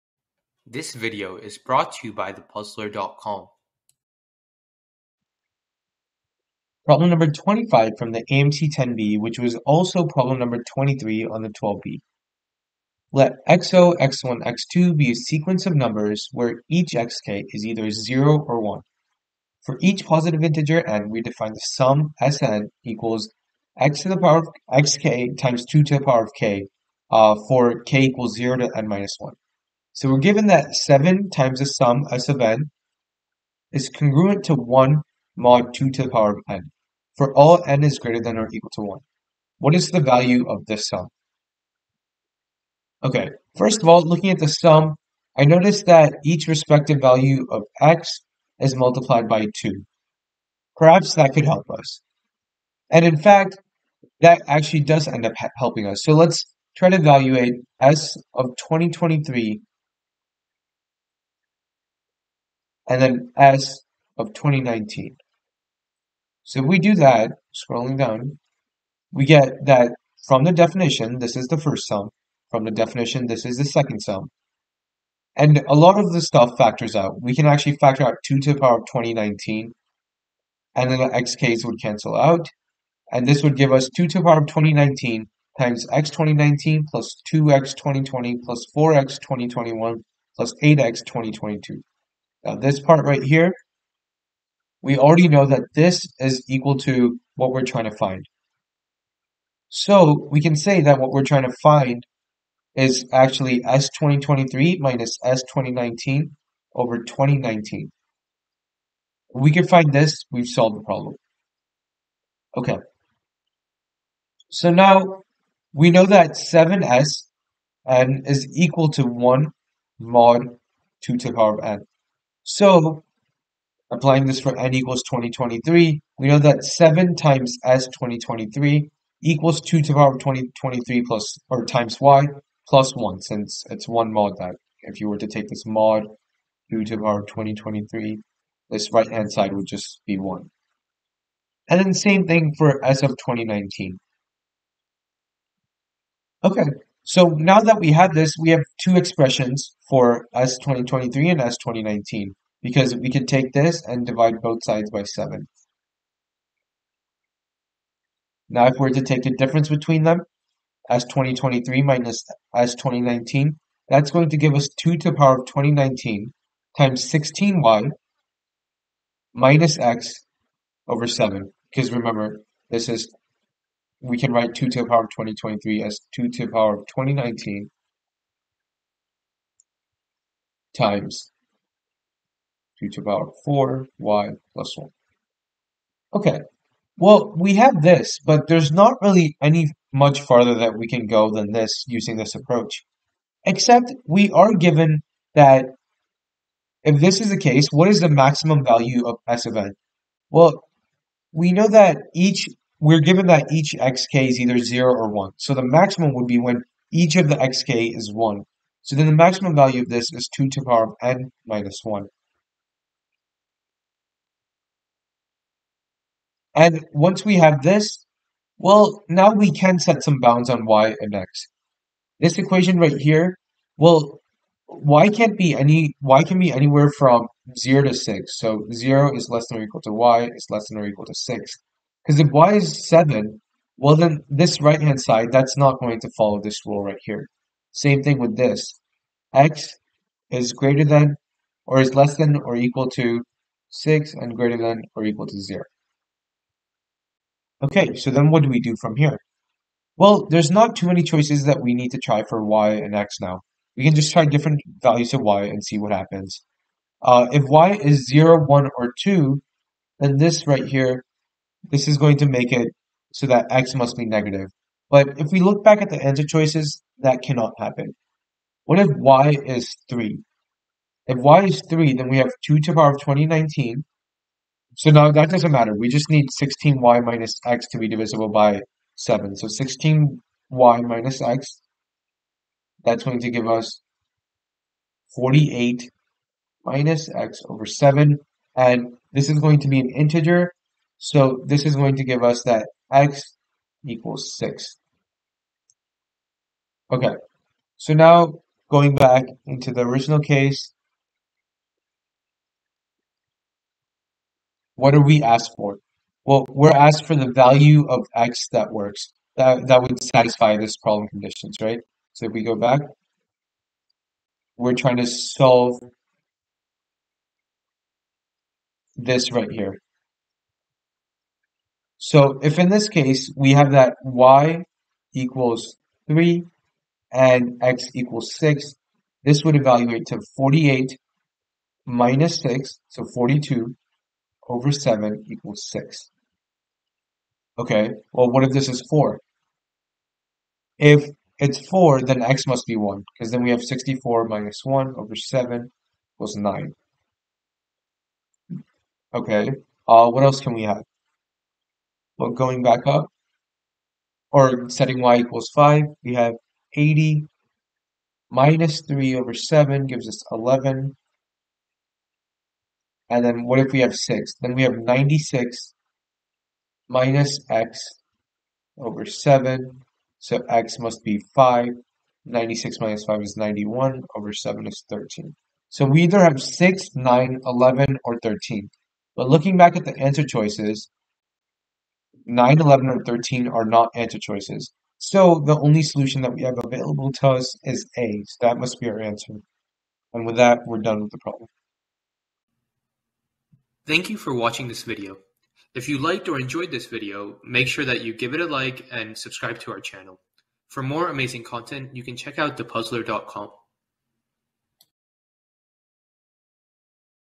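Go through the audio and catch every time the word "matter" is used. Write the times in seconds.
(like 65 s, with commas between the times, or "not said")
275 s.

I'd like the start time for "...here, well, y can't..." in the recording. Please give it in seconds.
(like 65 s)
222 s.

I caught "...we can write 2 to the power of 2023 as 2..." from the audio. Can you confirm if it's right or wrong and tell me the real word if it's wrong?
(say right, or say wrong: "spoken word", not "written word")
right.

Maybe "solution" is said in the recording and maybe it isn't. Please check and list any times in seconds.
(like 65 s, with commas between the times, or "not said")
385 s.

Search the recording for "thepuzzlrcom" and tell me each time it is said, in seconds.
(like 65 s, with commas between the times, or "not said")
2 s, 402 s.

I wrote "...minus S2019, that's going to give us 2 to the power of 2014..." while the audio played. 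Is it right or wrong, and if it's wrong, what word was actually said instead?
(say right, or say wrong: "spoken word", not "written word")
wrong: "2019", not "2014".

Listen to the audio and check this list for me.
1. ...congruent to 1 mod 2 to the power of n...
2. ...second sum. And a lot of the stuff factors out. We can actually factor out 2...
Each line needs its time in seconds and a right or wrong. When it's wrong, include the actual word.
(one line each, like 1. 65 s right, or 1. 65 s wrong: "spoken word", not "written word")
1. 33 s right
2. 73 s right.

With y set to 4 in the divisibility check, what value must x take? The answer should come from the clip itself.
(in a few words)
1.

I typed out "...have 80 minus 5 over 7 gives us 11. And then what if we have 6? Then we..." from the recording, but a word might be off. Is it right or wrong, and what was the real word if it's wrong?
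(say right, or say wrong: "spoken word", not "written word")
wrong: "3", not "5".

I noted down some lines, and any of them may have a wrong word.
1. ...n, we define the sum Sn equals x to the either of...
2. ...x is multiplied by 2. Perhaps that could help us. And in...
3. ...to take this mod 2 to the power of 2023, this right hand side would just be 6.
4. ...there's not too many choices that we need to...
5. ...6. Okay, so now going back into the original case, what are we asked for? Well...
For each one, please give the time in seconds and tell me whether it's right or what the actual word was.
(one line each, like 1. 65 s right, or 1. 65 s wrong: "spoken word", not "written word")
1. 20 s wrong: "power", not "either"
2. 47 s right
3. 135 s wrong: "1", not "6"
4. 250 s right
5. 294 s right.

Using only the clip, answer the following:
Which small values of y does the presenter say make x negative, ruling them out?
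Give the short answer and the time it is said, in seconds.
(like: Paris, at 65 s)
0, 1, or 2, at 258 s.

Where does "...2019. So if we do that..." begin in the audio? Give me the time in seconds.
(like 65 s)
64 s.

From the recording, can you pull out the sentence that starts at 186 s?
Okay, well, we have this, but there's not really any much farther that we can go than this using this approach.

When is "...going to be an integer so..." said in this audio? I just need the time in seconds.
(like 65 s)
289 s.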